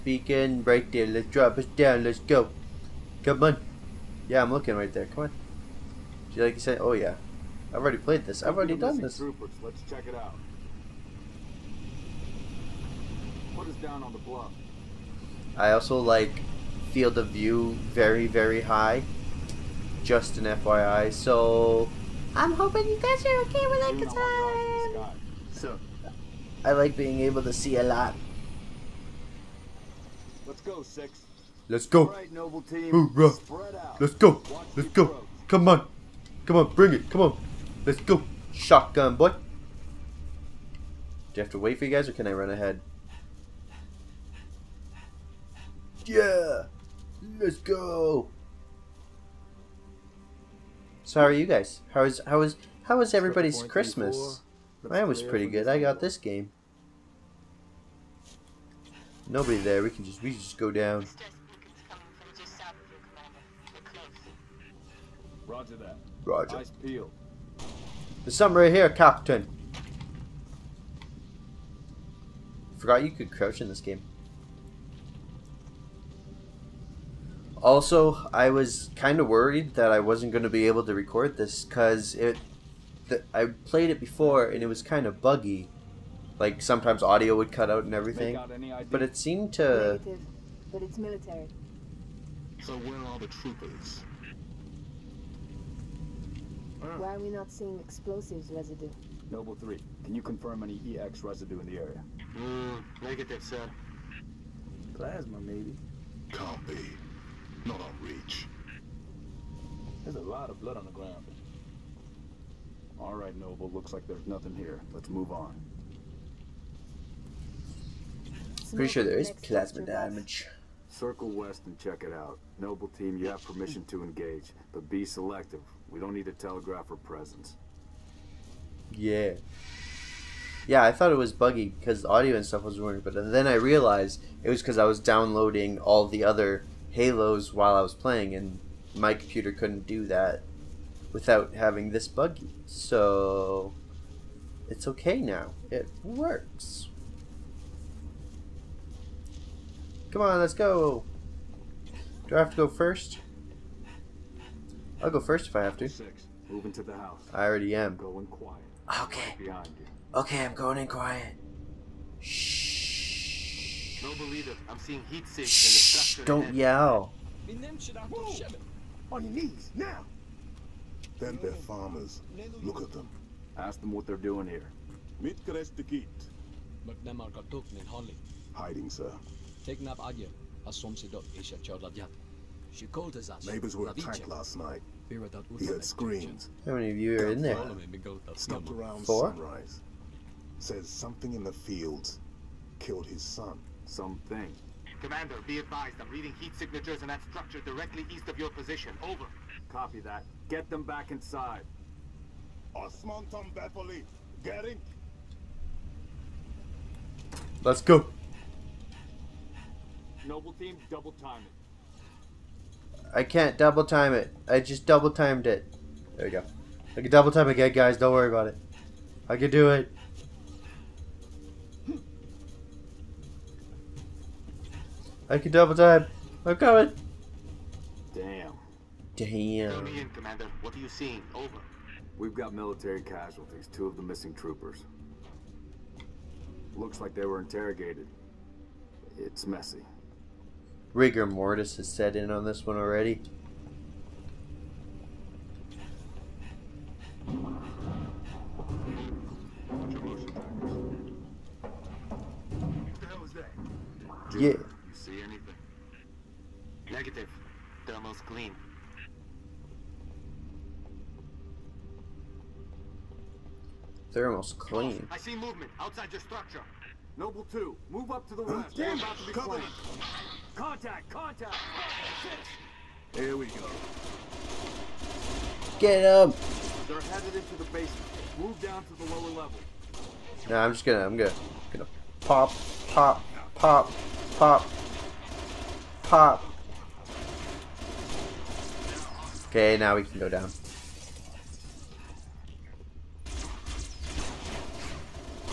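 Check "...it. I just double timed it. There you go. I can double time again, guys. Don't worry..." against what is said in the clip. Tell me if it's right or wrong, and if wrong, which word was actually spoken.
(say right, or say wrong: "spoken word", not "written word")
right.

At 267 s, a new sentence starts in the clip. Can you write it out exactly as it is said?
Noble 2, move up to the oh, west.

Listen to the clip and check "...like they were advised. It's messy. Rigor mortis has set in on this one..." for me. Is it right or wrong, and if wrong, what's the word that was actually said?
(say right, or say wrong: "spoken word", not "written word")
wrong: "interrogated", not "advised".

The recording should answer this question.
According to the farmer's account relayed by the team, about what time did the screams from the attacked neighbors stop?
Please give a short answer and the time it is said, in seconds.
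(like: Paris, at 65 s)
Sunrise, at 189 s.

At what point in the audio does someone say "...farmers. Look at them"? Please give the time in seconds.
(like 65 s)
171 s.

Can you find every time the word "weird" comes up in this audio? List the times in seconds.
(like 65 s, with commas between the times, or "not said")
132 s.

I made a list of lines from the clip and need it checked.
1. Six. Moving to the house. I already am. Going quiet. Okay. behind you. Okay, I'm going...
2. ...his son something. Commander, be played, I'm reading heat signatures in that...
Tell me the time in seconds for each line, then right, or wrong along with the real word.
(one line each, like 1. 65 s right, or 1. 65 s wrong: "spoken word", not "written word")
1. 155 s right
2. 193 s wrong: "advised", not "played".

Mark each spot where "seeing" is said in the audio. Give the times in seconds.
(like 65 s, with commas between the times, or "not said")
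97 s, 164 s, 230 s.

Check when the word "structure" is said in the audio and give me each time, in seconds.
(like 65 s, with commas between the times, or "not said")
197 s, 266 s.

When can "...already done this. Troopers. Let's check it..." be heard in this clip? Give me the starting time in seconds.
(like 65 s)
8 s.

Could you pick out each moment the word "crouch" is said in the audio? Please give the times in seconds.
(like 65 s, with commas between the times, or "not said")
73 s.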